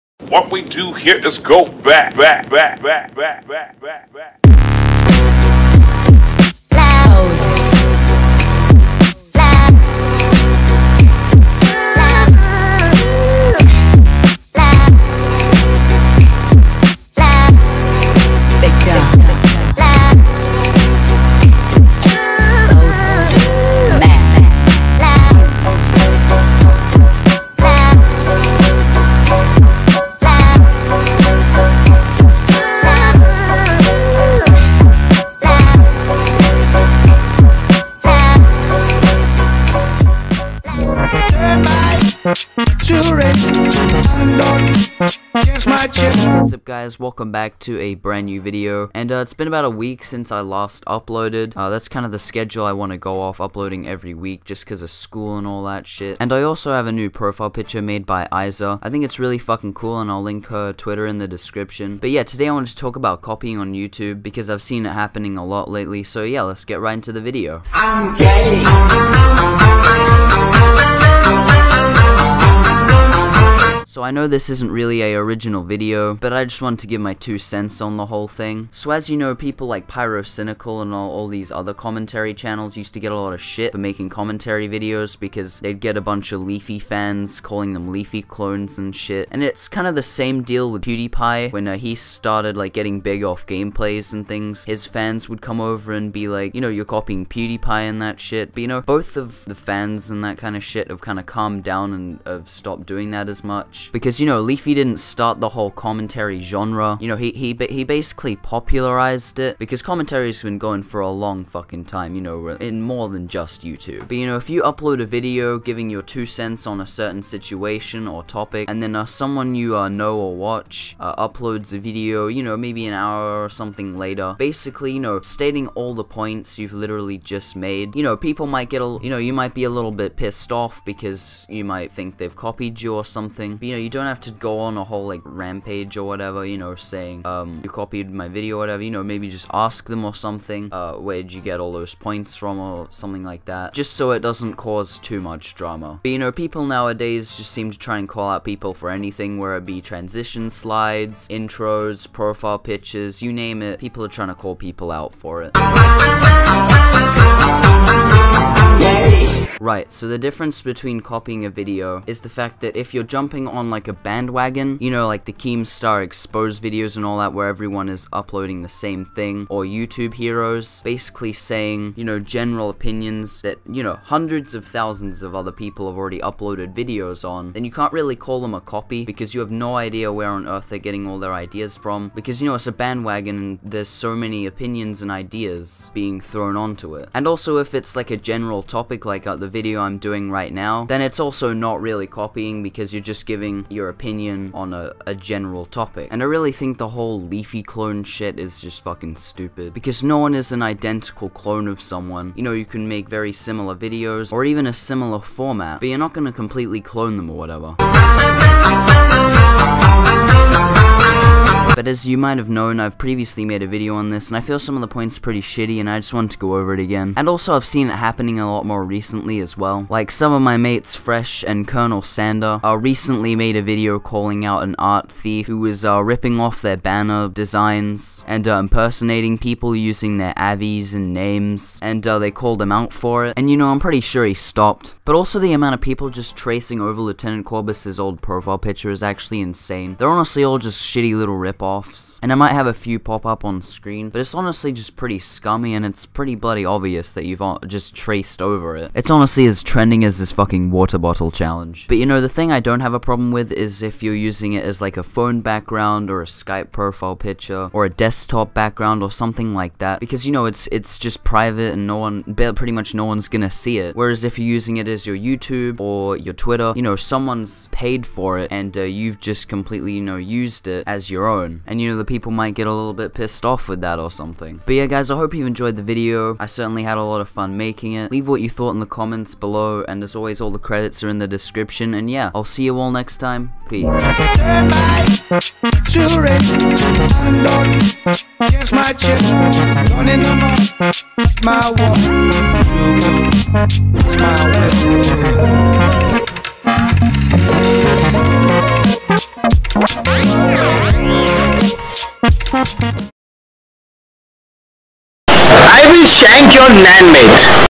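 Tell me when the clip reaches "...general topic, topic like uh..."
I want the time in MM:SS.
03:08.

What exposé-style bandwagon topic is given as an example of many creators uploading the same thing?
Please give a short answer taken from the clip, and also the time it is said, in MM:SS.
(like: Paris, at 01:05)
Keemstar Exposed, at 02:45.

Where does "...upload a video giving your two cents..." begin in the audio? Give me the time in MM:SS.
01:54.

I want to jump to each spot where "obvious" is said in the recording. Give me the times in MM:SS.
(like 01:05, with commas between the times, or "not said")
04:06.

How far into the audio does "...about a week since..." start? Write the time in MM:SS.
00:49.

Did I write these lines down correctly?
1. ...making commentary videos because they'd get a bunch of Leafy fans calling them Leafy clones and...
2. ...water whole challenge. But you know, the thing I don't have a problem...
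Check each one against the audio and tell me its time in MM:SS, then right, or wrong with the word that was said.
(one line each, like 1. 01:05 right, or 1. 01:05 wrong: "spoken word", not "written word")
1. 01:23 right
2. 04:10 wrong: "bottle", not "whole".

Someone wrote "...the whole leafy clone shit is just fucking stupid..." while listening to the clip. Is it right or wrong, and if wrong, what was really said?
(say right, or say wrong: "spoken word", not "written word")
right.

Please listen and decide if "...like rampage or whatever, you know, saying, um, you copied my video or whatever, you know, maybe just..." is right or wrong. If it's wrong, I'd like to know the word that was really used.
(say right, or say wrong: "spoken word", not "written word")
right.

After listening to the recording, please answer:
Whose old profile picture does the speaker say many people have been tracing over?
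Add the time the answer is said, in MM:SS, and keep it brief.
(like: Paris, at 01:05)
Lieutenant Corbis, at 03:57.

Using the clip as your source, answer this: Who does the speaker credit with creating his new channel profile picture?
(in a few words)
Iza.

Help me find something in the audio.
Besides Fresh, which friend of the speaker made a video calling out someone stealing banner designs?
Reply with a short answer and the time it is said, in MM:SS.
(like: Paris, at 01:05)
Colonel Sander, at 03:41.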